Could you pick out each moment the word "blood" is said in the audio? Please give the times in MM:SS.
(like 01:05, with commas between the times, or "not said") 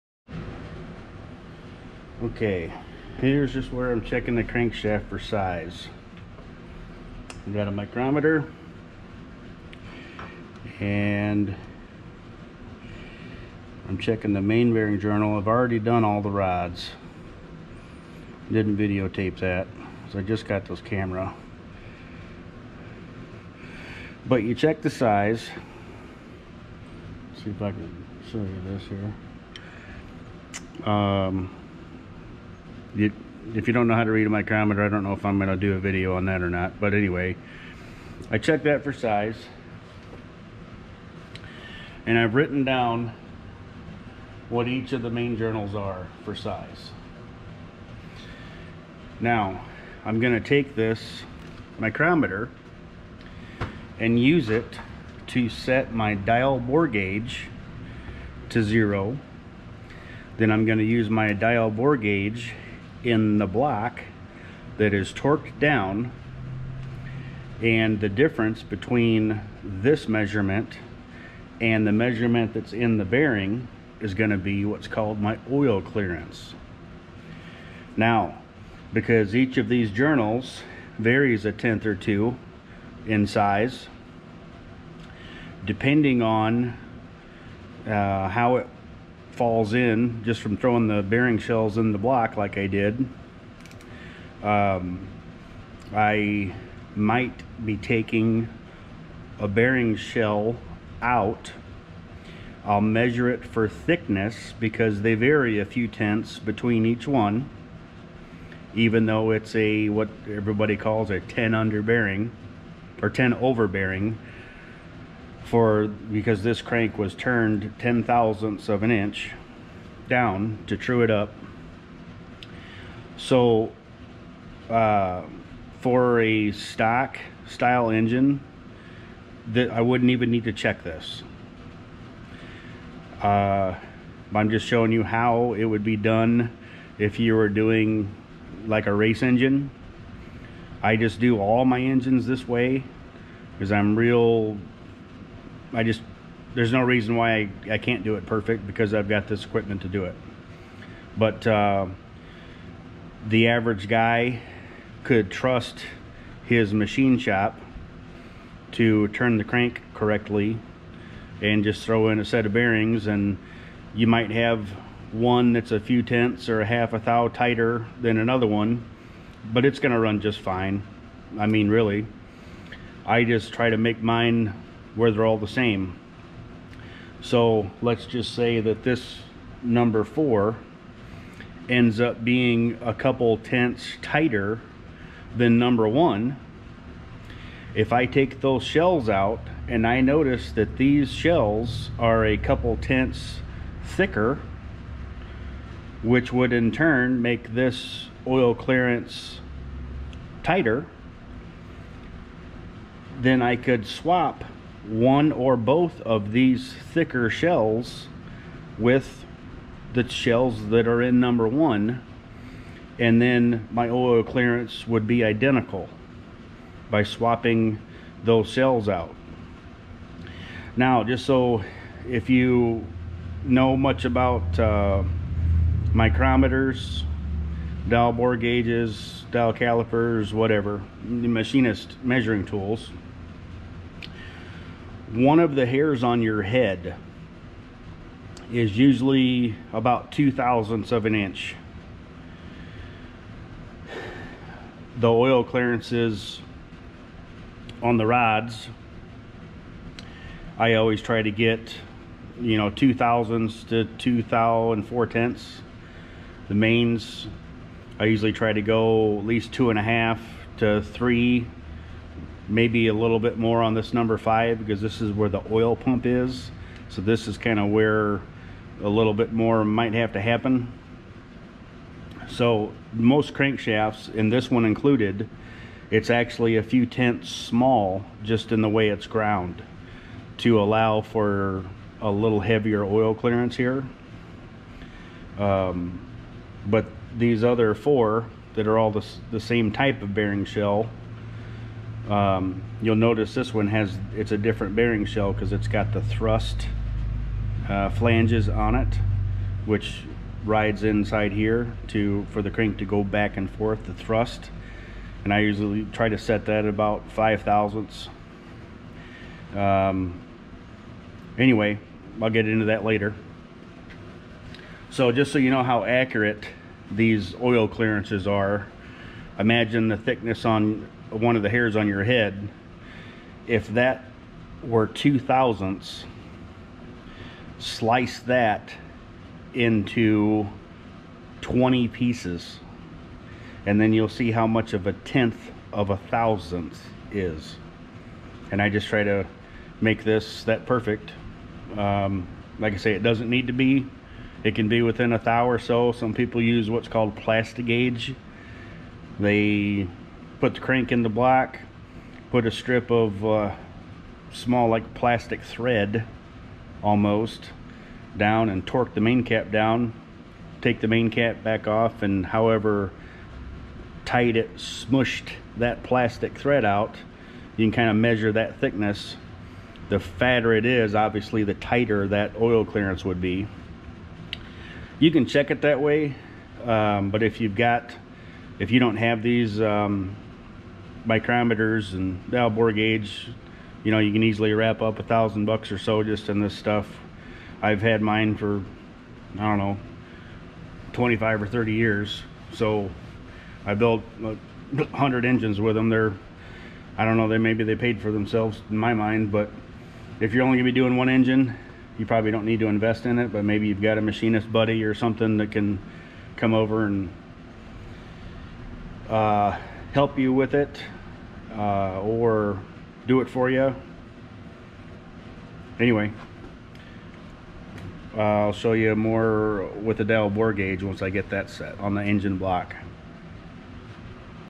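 not said.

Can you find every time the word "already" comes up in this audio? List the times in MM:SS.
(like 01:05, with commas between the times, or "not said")
00:15.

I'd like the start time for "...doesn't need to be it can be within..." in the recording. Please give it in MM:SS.
05:43.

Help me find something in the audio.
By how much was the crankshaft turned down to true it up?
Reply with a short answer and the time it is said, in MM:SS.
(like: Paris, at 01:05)
10 thousandths of an inch, at 01:57.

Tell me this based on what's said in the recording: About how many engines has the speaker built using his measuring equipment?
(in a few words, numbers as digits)
100.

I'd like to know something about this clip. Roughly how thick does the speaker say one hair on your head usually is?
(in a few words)
2 thousandths of an inch.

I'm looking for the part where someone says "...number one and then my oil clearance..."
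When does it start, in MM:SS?
03:31.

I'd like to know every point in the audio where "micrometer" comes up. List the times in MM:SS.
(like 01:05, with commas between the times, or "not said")
00:07, 00:34, 00:51, 03:45, 06:21.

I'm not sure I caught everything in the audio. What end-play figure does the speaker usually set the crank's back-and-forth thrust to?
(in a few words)
5 thousandths.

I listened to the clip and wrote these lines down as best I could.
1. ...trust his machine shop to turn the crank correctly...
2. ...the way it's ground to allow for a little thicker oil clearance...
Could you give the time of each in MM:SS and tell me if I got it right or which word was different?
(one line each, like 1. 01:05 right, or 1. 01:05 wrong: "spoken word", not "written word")
1. 02:35 right
2. 04:38 wrong: "heavier", not "thicker".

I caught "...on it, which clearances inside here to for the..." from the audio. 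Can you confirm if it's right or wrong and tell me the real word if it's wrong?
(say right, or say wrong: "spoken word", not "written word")
wrong: "rides", not "clearances".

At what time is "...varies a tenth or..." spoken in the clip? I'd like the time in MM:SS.
01:20.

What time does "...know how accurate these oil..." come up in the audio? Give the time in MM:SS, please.
05:15.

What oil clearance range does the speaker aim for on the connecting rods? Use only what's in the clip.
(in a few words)
2 to 2.4 thousandths.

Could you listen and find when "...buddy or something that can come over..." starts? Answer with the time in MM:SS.
06:44.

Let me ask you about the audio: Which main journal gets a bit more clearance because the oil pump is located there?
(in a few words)
Number 5.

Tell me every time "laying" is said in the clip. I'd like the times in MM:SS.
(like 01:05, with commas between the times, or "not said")
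not said.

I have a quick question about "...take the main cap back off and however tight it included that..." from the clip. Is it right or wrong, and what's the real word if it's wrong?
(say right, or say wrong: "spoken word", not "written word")
wrong: "smushed", not "included".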